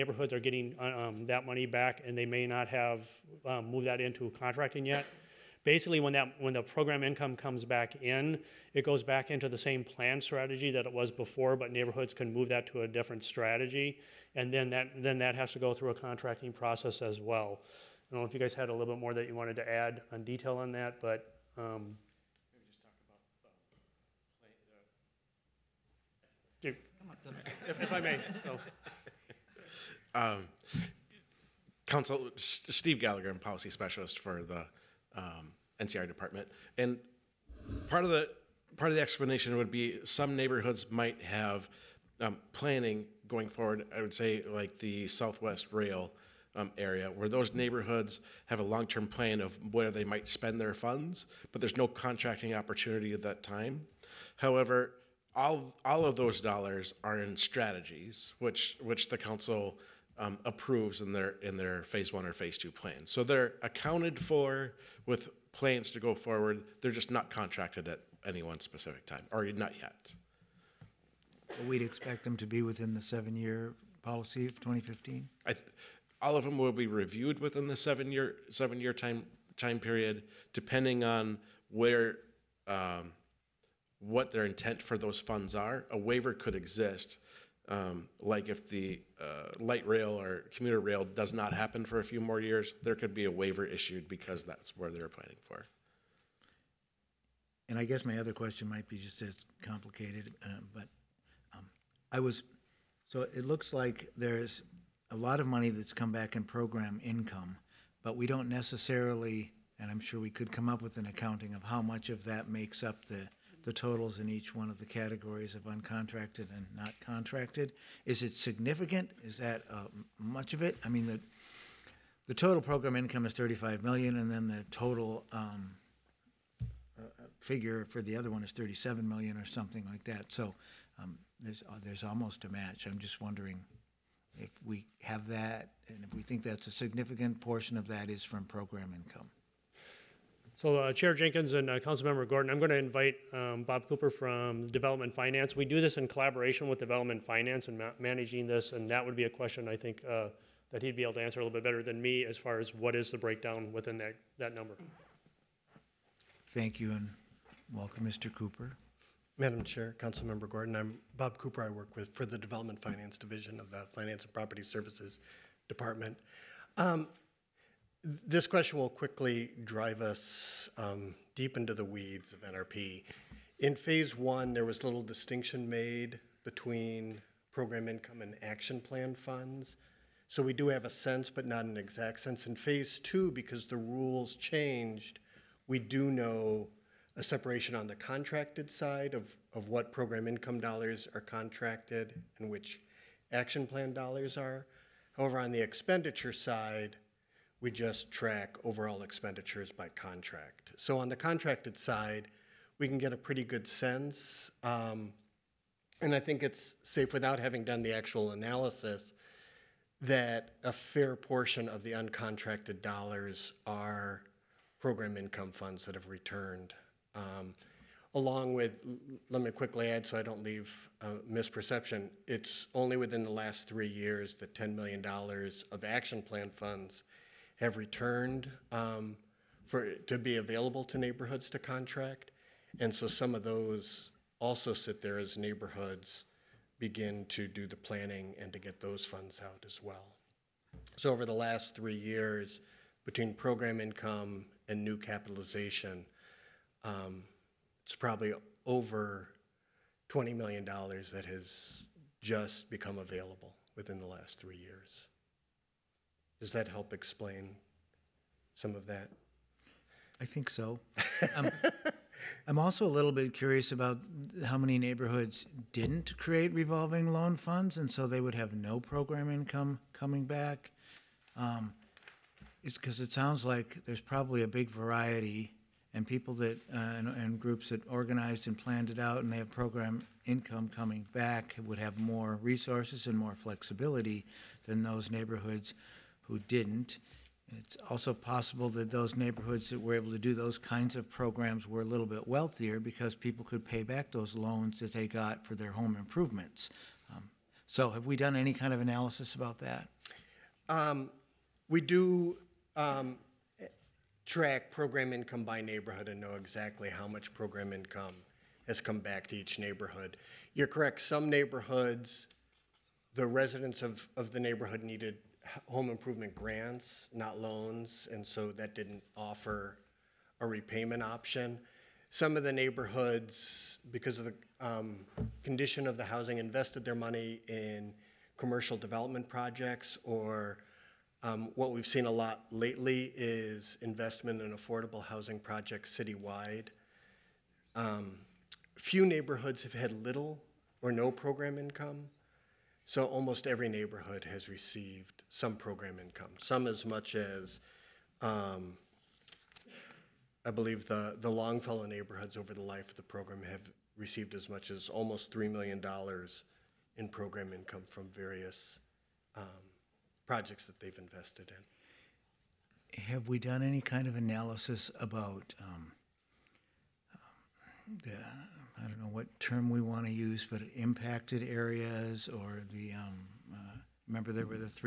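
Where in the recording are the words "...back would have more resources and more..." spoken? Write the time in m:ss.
4:41.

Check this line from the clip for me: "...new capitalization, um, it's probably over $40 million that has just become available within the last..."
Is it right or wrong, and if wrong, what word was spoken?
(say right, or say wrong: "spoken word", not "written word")
wrong: "20", not "40".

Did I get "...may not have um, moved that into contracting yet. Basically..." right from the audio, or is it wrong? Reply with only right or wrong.
right.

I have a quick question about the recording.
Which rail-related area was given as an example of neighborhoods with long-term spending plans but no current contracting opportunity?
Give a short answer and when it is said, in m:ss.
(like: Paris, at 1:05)
Southwest Rail, at 0:45.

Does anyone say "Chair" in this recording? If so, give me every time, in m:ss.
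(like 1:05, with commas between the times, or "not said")
2:20, 2:39.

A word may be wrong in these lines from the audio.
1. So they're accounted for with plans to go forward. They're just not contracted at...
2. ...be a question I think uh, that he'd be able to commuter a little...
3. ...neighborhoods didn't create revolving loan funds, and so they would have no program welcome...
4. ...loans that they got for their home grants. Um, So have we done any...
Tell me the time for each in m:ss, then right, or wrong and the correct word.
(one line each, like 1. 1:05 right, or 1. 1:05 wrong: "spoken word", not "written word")
1. 1:03 right
2. 2:29 wrong: "answer", not "commuter"
3. 4:24 wrong: "income", not "welcome"
4. 4:54 wrong: "improvements", not "grants".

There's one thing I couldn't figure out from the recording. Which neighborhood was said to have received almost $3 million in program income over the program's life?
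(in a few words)
Longfellow.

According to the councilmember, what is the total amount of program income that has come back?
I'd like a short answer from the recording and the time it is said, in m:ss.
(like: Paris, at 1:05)
35 million, at 2:03.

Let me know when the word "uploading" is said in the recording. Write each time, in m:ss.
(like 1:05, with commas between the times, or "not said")
not said.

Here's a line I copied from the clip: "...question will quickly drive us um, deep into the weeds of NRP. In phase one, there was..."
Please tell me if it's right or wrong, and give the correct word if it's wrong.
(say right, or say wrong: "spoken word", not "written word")
right.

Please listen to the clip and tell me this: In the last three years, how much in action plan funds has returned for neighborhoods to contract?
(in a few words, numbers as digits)
$10 million.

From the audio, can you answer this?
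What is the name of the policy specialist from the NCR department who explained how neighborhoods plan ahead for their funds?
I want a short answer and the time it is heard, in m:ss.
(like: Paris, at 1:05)
Steve Gallagher, at 0:32.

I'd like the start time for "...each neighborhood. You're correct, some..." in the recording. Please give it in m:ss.
5:09.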